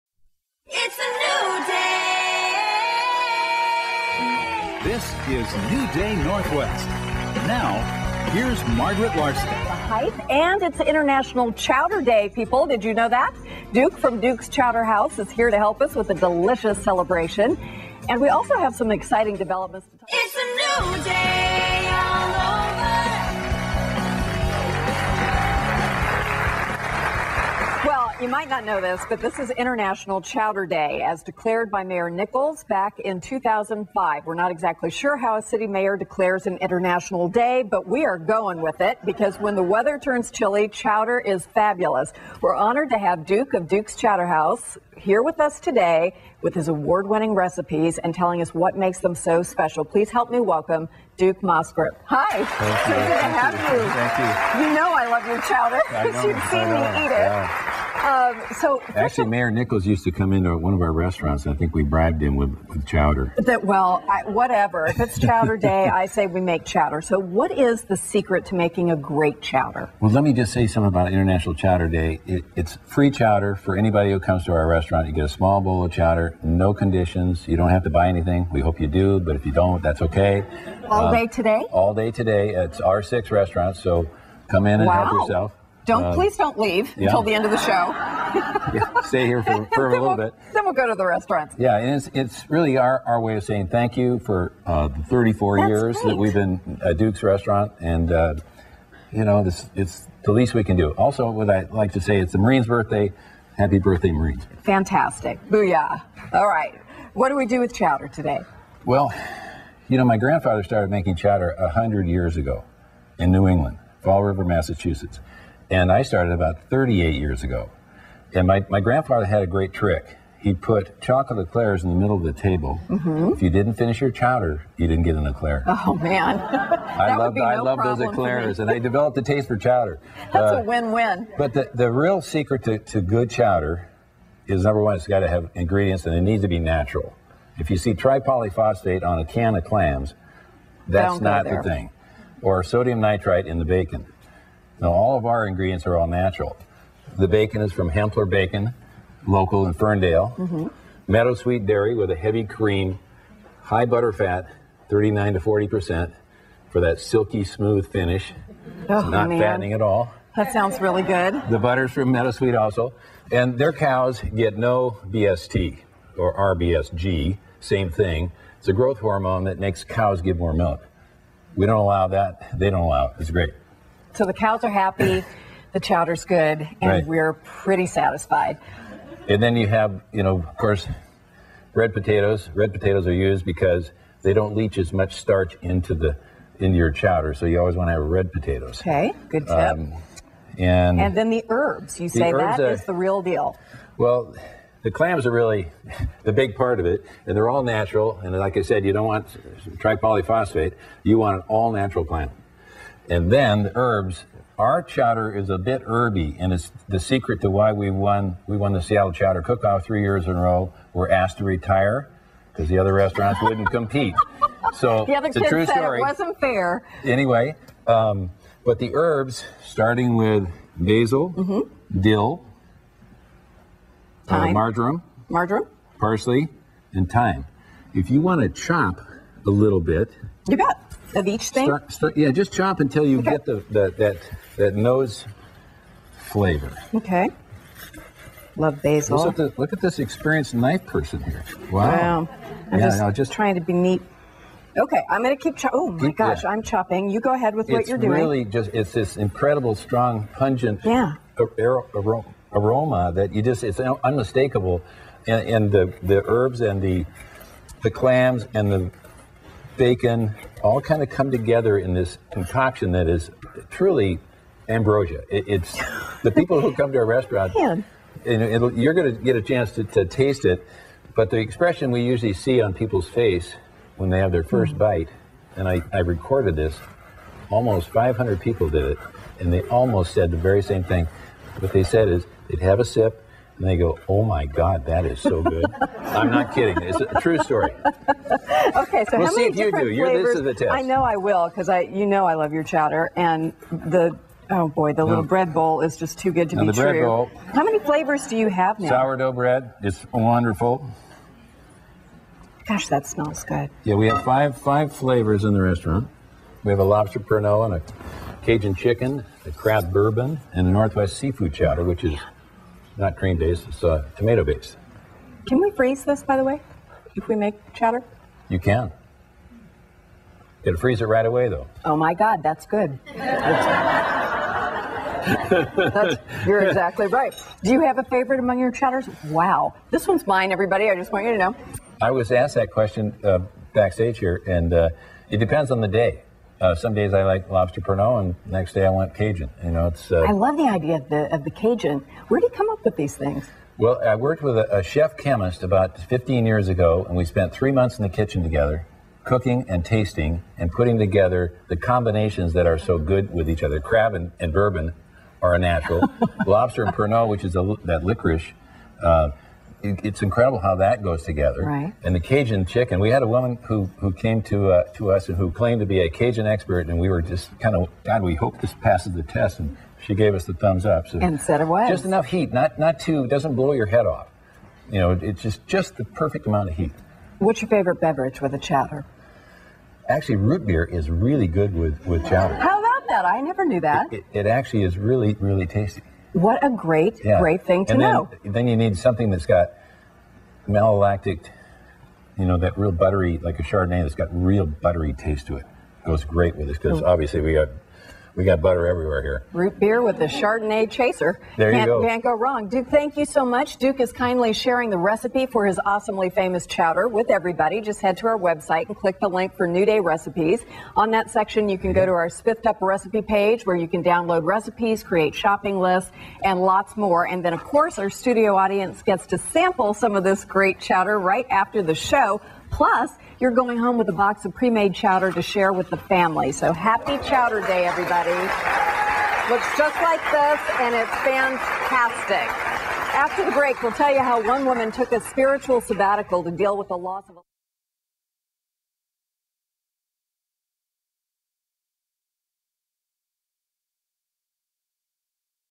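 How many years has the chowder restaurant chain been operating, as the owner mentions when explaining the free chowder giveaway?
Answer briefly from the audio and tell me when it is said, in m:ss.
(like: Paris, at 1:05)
34, at 1:35.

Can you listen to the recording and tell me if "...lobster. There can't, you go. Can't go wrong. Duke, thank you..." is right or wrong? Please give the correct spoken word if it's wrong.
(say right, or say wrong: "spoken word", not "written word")
wrong: "chaser", not "lobster".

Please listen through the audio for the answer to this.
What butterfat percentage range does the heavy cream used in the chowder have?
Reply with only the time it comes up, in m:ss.
2:34.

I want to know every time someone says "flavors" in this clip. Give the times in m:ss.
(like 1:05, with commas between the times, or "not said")
3:56, 4:49, 4:57, 5:04.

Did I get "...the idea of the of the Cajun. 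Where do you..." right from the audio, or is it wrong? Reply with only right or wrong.
right.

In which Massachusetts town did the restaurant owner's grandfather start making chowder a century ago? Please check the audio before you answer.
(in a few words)
Fall River.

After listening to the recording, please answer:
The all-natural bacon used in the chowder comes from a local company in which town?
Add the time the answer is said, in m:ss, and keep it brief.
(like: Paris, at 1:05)
Ferndale, at 2:29.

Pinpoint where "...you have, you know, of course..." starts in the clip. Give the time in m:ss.
2:59.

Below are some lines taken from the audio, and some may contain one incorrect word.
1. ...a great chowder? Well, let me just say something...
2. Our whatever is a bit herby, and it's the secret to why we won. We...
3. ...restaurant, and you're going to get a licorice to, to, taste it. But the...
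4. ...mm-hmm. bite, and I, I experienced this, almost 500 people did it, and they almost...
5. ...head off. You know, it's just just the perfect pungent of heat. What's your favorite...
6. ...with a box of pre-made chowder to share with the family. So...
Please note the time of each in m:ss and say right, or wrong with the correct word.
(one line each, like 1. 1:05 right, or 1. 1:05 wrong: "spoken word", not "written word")
1. 1:08 right
2. 3:24 wrong: "chowder", not "whatever"
3. 4:27 wrong: "chance", not "licorice"
4. 4:34 wrong: "recorded", not "experienced"
5. 6:13 wrong: "amount", not "pungent"
6. 7:03 right.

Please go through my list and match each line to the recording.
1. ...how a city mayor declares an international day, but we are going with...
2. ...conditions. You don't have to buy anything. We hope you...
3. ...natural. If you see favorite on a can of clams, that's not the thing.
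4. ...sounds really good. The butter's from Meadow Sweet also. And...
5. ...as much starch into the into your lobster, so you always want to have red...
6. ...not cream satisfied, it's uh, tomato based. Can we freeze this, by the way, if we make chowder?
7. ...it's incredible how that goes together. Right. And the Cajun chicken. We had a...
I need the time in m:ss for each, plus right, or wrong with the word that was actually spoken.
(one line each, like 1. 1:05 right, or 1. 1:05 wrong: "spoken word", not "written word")
1. 0:35 right
2. 1:16 right
3. 2:16 wrong: "tripolyphosphate", not "favorite"
4. 2:40 right
5. 3:04 wrong: "chowder", not "lobster"
6. 5:12 wrong: "based", not "satisfied"
7. 6:00 right.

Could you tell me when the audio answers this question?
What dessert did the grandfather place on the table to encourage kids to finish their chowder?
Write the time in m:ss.
2:01.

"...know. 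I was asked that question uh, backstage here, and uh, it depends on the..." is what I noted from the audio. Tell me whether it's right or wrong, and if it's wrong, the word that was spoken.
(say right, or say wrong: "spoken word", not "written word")
right.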